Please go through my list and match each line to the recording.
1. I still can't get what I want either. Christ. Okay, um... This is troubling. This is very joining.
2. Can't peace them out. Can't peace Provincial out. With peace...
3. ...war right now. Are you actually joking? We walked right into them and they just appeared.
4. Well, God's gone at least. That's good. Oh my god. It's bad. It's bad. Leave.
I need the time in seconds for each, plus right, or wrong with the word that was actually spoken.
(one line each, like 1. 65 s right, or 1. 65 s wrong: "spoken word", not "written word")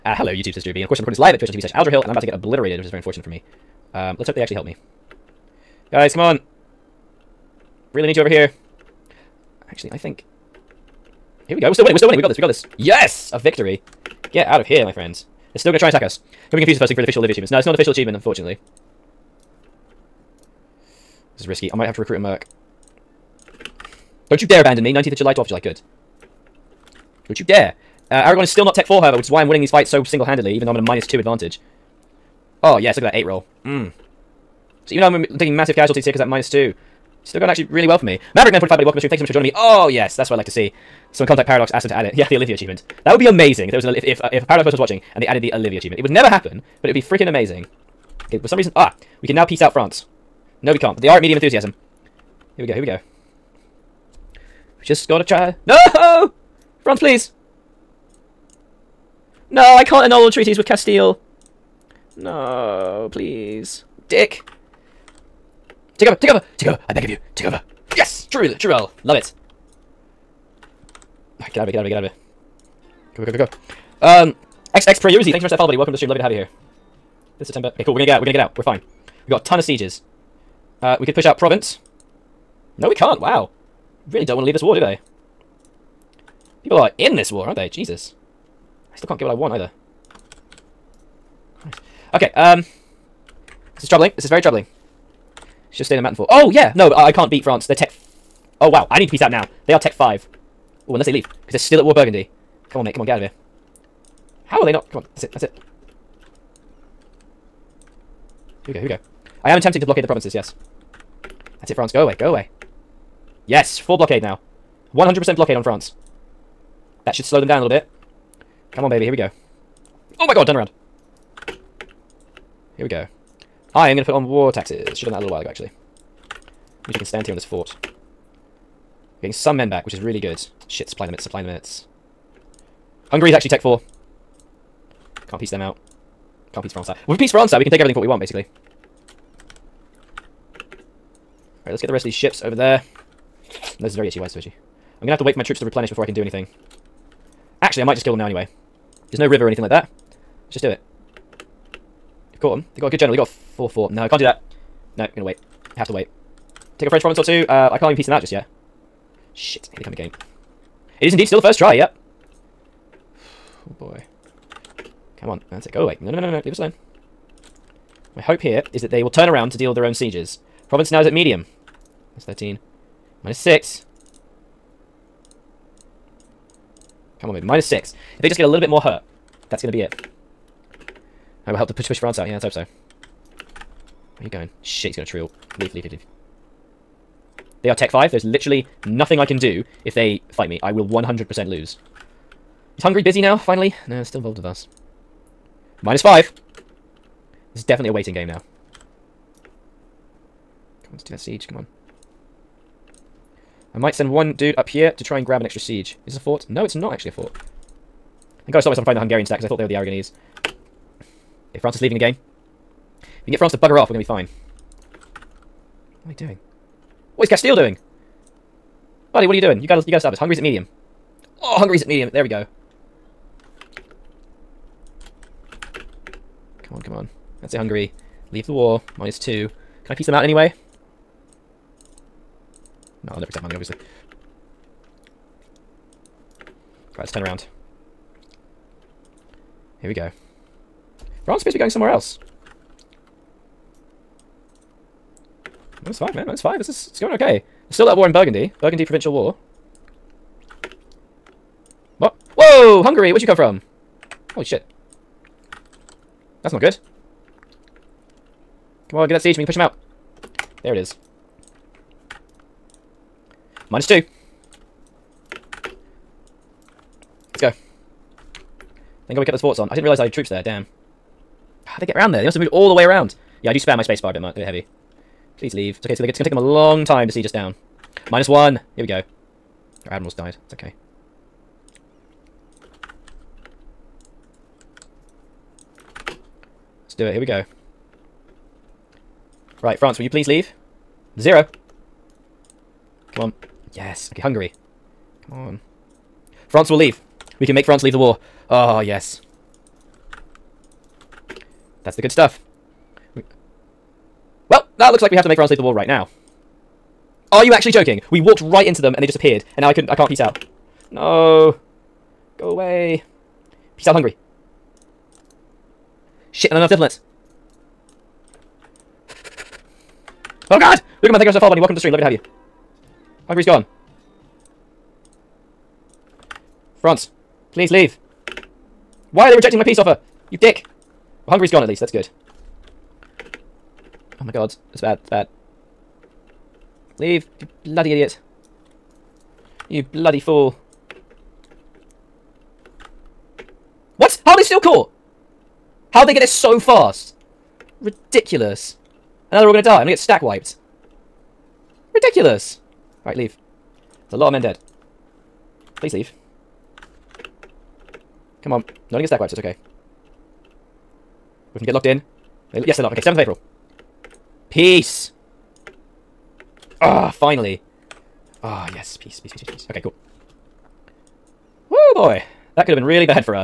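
1. 88 s wrong: "troubling", not "joining"
2. 135 s wrong: "France", not "Provincial"
3. 305 s right
4. 331 s wrong: "Hungary", not "God".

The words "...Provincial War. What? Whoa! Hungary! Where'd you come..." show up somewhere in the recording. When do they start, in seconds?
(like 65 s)
248 s.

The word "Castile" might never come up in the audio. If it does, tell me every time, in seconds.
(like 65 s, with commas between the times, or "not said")
60 s, 217 s.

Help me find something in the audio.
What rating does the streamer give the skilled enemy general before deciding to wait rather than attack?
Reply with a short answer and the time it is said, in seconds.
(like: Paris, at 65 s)
4-4, at 153 s.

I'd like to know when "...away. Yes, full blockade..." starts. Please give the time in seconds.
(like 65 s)
112 s.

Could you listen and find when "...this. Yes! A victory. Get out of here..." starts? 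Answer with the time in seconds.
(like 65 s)
12 s.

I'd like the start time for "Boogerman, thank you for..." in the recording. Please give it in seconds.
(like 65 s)
321 s.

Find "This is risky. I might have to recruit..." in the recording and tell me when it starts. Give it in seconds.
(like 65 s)
21 s.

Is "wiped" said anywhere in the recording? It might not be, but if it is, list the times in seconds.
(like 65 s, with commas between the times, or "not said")
350 s, 359 s.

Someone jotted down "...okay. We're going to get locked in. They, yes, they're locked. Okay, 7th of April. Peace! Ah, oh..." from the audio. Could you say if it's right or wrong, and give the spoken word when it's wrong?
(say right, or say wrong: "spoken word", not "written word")
right.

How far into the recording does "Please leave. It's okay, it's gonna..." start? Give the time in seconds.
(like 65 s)
275 s.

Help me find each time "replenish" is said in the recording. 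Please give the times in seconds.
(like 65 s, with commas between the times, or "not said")
145 s.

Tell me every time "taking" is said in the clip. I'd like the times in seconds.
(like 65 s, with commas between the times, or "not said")
35 s.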